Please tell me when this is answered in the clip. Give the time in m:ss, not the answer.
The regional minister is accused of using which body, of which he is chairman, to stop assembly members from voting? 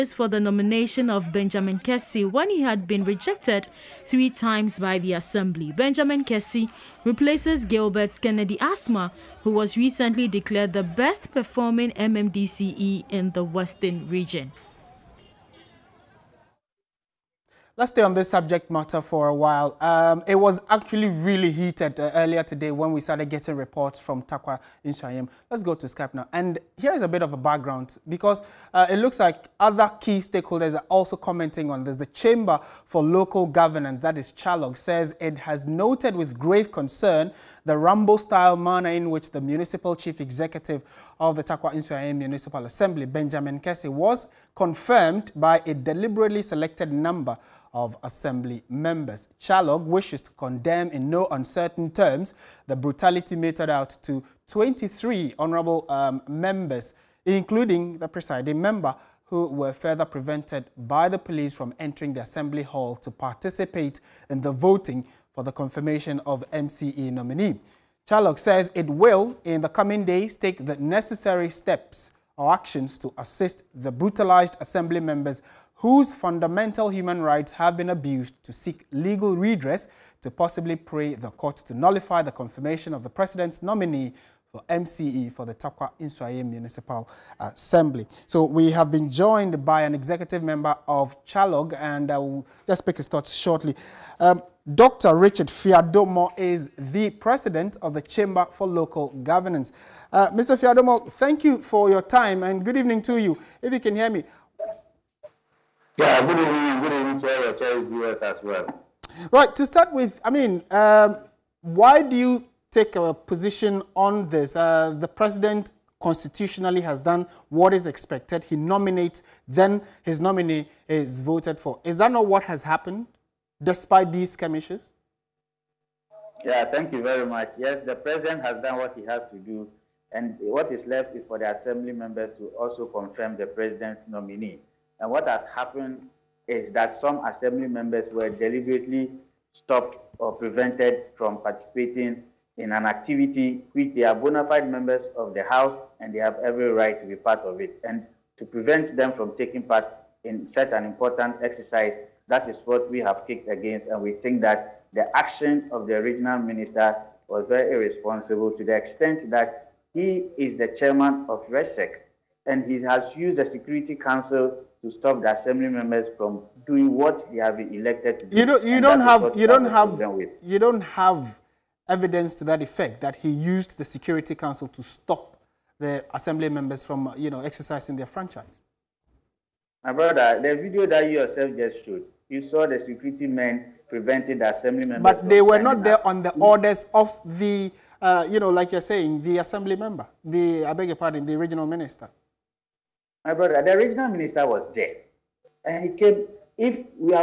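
2:41.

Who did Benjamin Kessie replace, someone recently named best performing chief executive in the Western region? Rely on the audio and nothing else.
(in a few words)
Gilbert Kennedy Asmah.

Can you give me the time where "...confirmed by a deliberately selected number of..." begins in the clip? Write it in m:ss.
0:44.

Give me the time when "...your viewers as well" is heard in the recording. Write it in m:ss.
1:47.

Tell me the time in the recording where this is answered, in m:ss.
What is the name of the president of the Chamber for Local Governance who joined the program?
1:34.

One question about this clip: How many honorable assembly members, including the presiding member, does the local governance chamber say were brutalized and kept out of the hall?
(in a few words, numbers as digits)
23.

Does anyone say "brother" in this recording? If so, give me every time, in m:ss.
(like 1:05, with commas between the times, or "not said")
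2:59, 3:13.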